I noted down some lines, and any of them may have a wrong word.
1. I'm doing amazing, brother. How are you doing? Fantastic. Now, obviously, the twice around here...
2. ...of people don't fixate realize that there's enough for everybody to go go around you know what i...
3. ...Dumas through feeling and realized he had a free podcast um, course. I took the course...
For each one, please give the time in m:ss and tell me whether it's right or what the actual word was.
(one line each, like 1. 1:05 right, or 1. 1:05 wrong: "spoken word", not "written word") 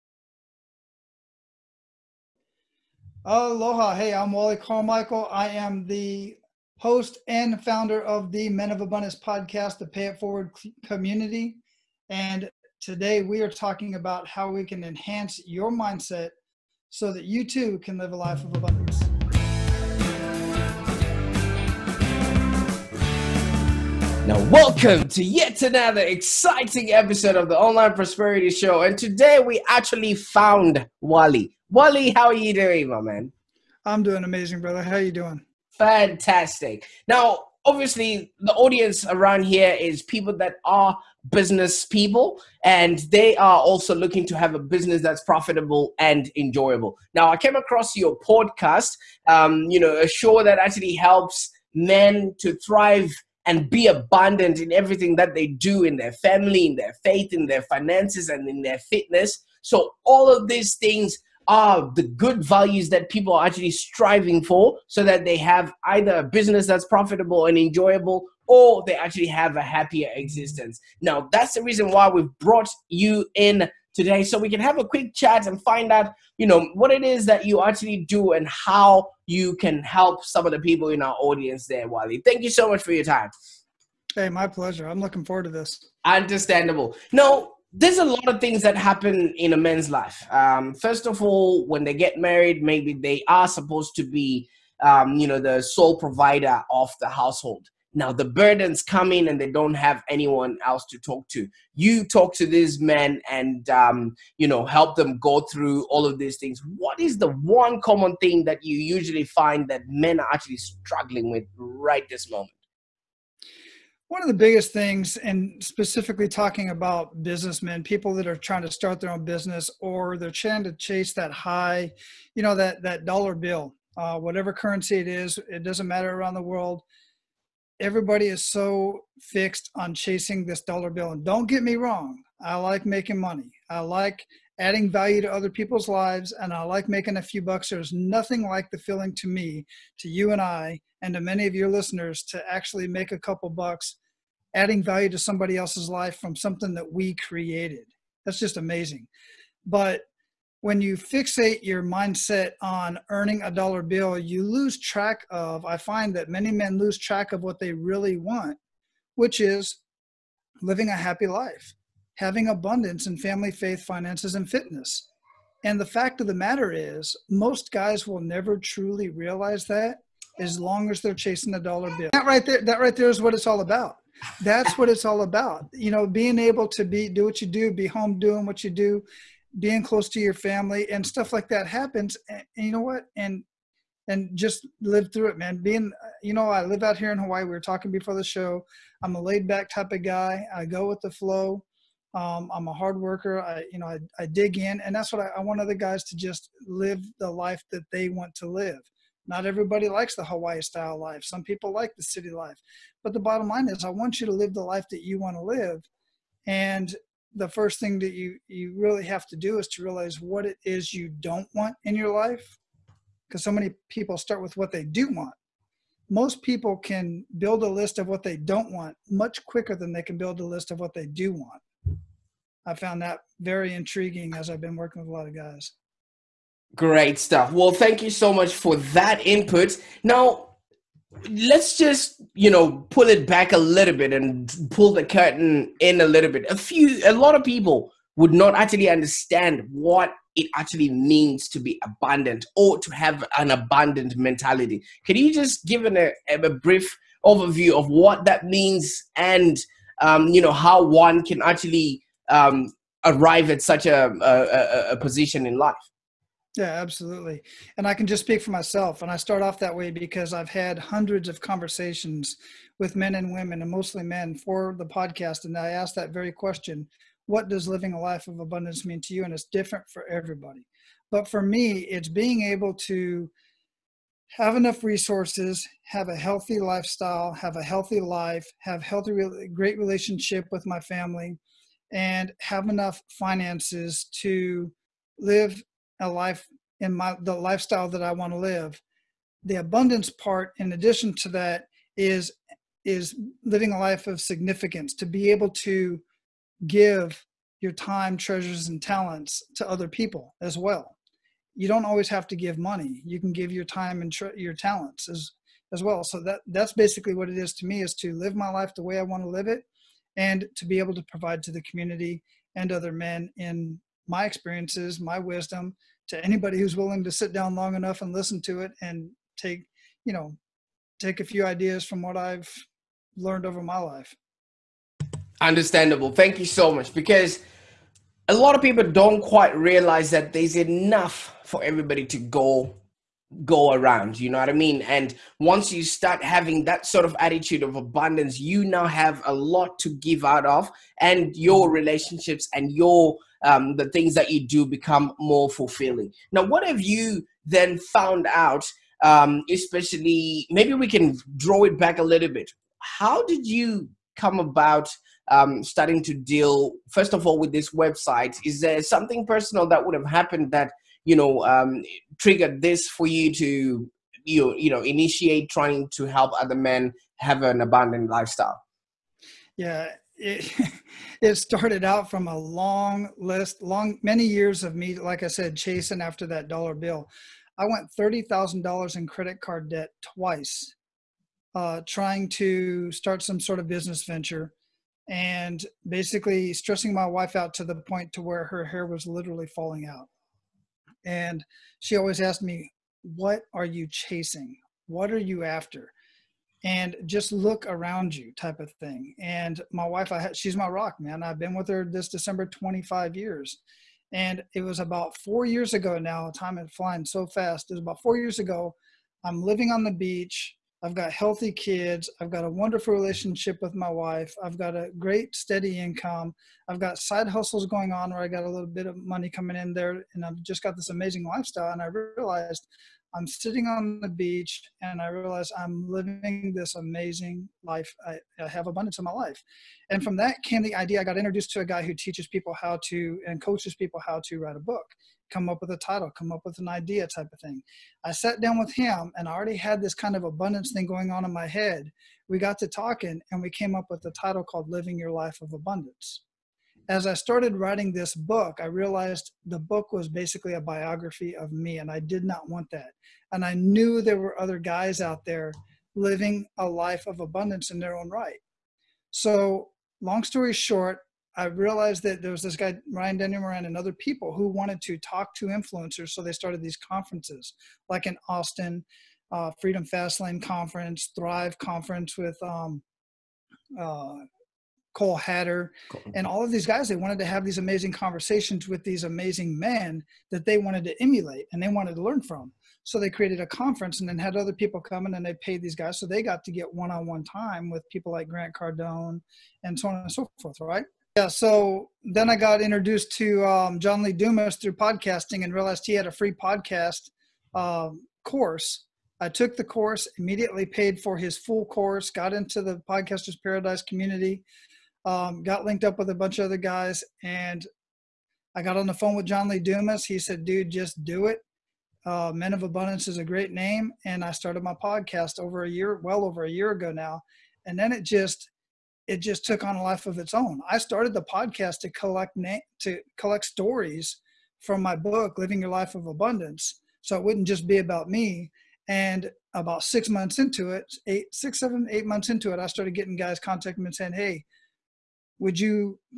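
1. 0:33 wrong: "audience", not "twice"
2. 5:28 wrong: "quite", not "fixate"
3. 8:14 wrong: "podcasting", not "feeling".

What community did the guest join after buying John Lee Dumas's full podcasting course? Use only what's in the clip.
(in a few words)
Podcasters Paradise.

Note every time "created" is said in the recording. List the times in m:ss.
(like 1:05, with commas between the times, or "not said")
2:27, 8:03.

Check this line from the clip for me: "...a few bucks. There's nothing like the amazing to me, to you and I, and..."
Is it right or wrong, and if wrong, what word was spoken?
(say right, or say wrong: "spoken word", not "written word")
wrong: "feeling", not "amazing".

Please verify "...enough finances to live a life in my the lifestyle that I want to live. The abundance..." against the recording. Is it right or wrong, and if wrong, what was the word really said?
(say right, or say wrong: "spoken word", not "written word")
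right.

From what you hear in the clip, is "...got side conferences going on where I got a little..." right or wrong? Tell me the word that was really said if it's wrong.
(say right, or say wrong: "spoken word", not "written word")
wrong: "hustles", not "conferences".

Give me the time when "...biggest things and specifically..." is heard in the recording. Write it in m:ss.
1:54.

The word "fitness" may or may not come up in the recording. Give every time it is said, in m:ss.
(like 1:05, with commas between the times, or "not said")
0:58, 2:44.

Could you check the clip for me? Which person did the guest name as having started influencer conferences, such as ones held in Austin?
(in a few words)
Ryan Moran.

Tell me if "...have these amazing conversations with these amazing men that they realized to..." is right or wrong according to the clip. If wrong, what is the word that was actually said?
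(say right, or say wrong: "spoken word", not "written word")
wrong: "wanted", not "realized".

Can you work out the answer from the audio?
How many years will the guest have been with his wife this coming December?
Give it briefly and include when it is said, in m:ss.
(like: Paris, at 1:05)
25, at 6:42.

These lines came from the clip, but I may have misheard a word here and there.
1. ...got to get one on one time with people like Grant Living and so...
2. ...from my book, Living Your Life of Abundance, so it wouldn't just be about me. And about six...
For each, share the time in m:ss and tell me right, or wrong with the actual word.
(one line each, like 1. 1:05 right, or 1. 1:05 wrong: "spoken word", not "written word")
1. 8:06 wrong: "Cardone", not "Living"
2. 8:44 right.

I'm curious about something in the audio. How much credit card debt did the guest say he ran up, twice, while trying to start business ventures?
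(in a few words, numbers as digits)
$30,000.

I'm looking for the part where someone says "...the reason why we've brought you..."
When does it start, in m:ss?
1:11.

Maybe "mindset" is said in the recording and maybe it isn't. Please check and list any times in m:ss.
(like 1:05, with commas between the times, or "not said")
0:15, 2:31.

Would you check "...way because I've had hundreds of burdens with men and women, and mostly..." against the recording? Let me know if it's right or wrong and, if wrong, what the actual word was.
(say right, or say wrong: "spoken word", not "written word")
wrong: "conversations", not "burdens".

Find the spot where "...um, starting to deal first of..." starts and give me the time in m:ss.
5:55.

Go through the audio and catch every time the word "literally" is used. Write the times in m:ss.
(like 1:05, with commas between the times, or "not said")
6:29.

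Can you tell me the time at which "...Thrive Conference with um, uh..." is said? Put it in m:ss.
7:51.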